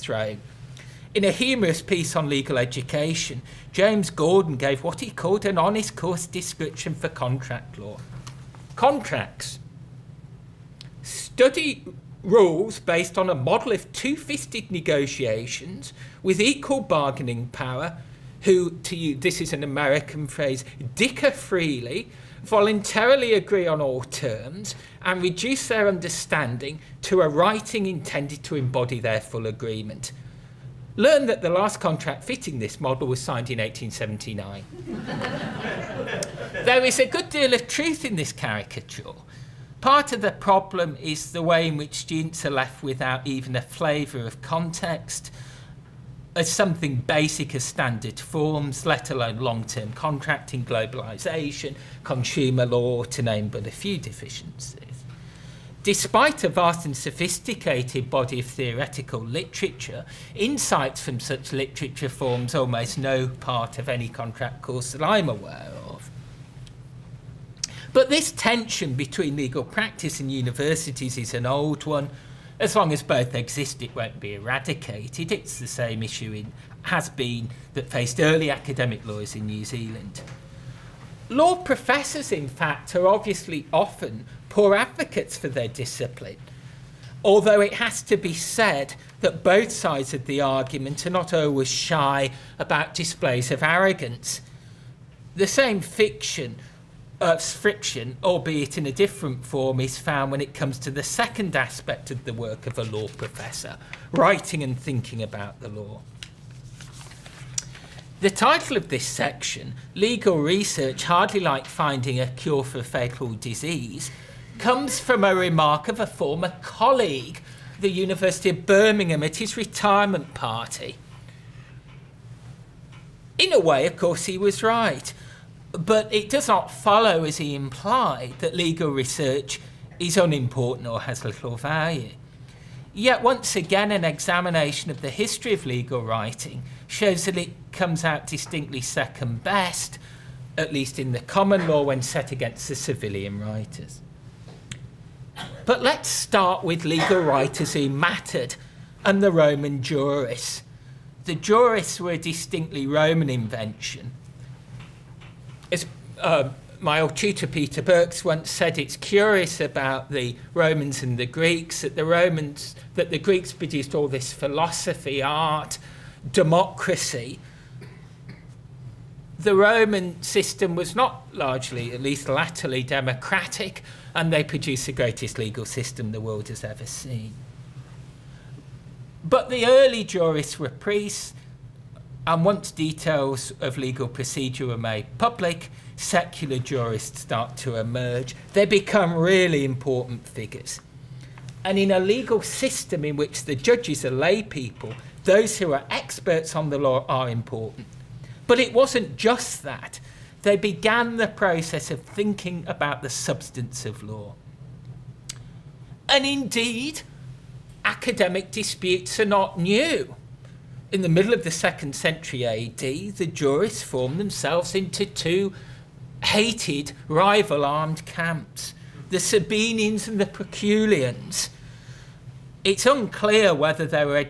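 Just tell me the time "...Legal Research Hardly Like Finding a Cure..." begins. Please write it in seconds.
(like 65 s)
109 s.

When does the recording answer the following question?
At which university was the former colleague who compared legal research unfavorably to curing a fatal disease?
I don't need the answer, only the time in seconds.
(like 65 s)
117 s.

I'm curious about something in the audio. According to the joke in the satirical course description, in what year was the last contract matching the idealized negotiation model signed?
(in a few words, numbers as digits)
1879.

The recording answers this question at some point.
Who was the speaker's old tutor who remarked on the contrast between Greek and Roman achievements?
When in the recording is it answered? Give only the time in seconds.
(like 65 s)
157 s.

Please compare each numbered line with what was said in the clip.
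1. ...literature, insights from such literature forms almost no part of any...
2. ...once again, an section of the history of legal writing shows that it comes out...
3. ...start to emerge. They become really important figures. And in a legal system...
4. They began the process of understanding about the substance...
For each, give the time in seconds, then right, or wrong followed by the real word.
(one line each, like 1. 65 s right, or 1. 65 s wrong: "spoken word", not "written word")
1. 59 s right
2. 133 s wrong: "examination", not "section"
3. 187 s right
4. 200 s wrong: "thinking", not "understanding".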